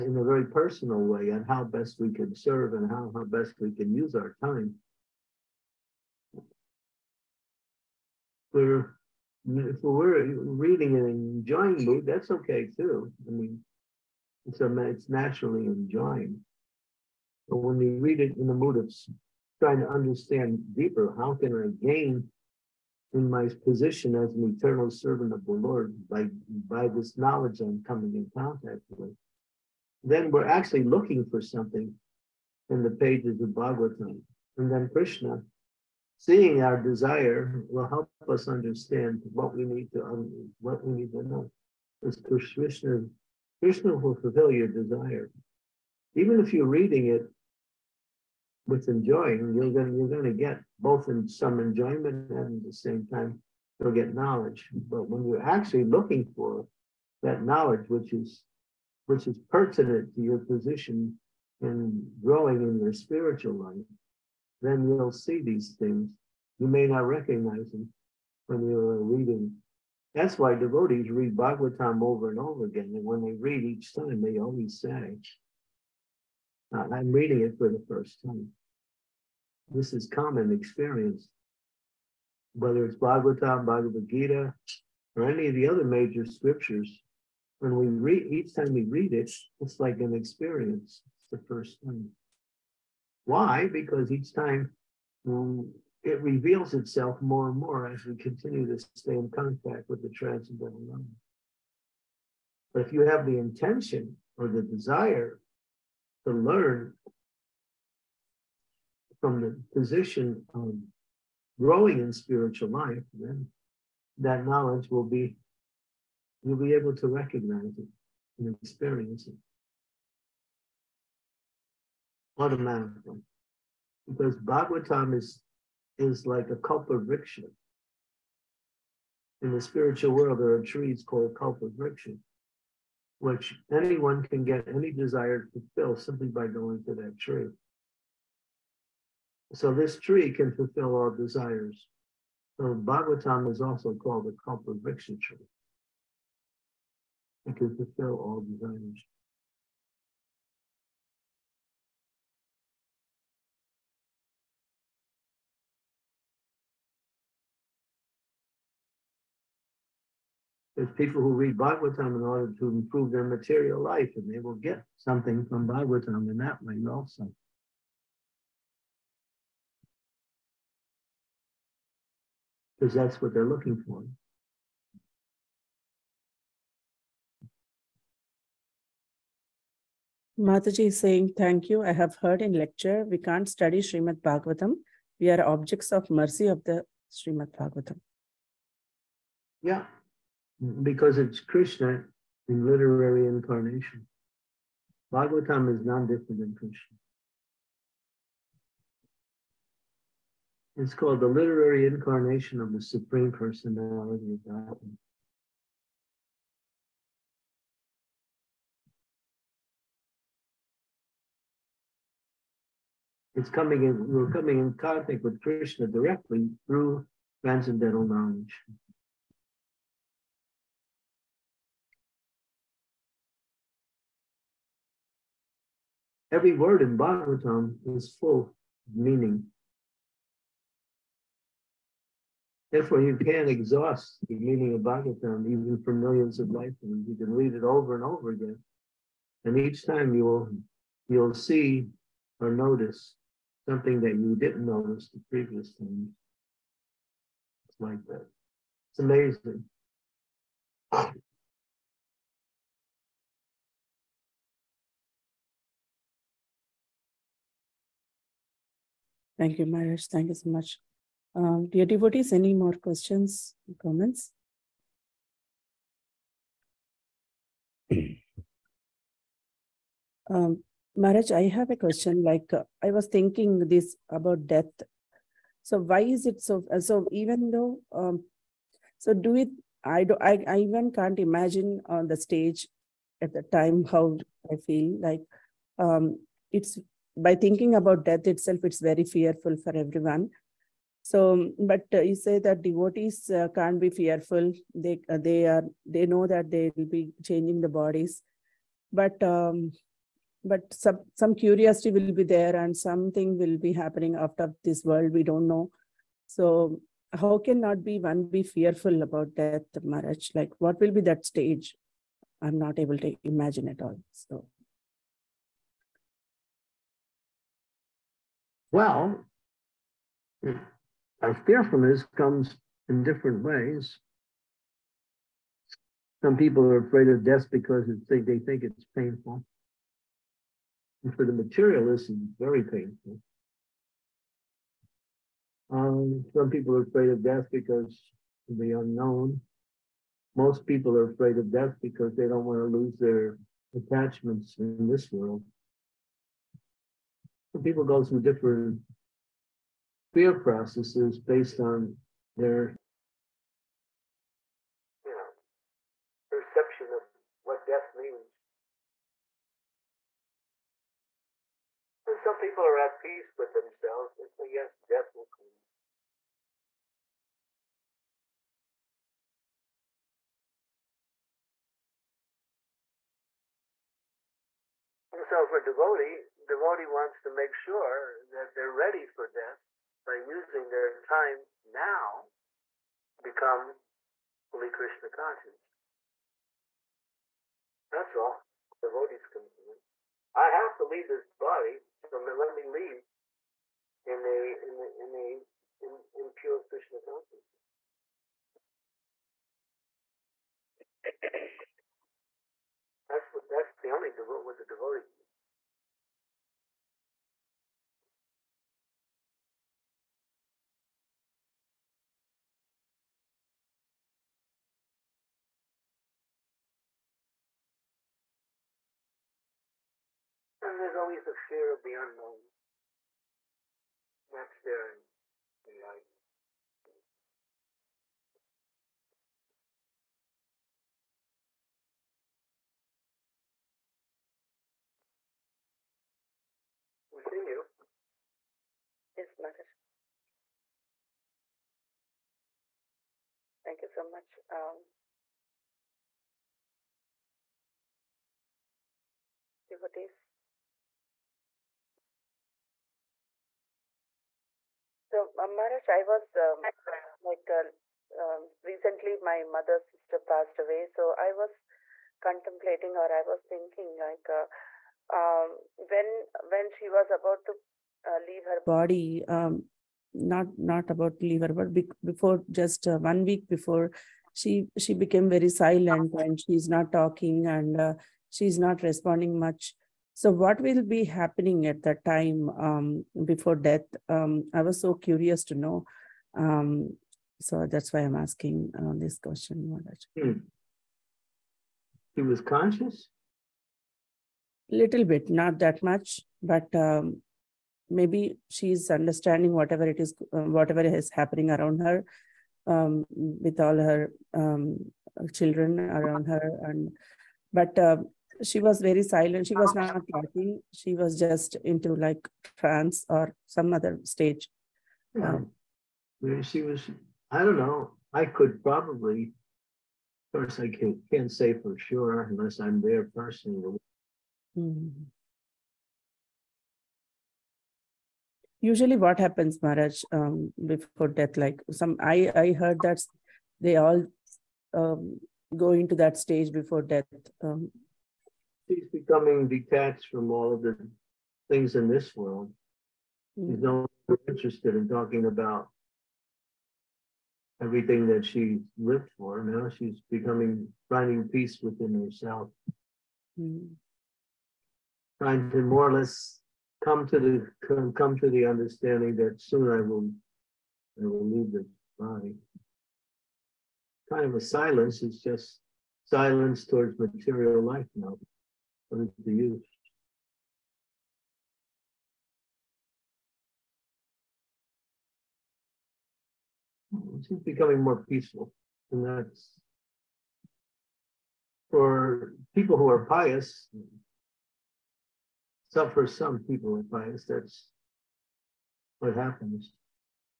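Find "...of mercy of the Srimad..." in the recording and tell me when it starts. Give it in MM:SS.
03:05.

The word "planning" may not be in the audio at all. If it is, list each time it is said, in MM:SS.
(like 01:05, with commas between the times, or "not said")
not said.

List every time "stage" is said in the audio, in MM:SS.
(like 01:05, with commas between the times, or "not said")
04:42, 05:11, 08:34, 08:56.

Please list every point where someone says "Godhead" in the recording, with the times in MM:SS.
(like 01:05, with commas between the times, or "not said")
03:24.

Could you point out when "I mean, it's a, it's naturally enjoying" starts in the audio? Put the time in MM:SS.
00:13.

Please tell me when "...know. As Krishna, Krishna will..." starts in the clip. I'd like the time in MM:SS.
00:41.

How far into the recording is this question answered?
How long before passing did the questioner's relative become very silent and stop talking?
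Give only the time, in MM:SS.
07:52.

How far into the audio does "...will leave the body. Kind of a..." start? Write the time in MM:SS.
09:21.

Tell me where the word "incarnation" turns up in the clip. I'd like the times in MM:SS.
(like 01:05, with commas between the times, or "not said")
03:13, 03:21.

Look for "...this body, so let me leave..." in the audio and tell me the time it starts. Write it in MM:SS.
06:31.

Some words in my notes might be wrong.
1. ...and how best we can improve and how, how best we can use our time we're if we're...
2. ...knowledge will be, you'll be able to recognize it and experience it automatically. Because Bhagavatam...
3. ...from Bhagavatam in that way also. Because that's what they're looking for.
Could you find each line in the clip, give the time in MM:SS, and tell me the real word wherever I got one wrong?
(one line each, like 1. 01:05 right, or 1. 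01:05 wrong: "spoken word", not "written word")
1. 00:01 wrong: "serve", not "improve"
2. 01:54 right
3. 02:45 right.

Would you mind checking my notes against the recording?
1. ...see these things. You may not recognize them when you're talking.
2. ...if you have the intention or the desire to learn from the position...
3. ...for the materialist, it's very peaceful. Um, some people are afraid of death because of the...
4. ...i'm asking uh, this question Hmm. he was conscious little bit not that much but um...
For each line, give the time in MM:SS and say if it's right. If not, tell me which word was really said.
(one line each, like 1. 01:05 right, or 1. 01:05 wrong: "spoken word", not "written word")
1. 01:05 wrong: "reading", not "talking"
2. 01:42 right
3. 05:31 wrong: "painful", not "peaceful"
4. 08:07 right.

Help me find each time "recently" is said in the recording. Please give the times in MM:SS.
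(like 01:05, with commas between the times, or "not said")
07:38.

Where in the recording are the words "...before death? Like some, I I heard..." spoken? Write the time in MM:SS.
08:50.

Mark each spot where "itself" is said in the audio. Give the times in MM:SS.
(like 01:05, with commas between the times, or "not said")
01:36, 04:48.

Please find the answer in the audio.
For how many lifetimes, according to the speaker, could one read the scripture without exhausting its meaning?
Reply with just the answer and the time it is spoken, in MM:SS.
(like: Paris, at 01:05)
millions of lifetimes, at 03:55.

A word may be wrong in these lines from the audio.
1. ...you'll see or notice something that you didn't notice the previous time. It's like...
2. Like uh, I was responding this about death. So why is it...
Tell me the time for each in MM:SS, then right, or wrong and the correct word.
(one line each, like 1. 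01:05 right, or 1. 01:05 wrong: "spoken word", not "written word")
1. 04:01 right
2. 04:32 wrong: "thinking", not "responding".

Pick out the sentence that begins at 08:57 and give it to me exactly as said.
Um, He's becoming detached from all of the things in this world.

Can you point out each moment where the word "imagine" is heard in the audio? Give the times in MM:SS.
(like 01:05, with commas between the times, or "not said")
04:41, 05:13.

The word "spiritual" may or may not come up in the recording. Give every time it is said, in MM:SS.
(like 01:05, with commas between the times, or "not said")
01:02, 01:52, 02:09.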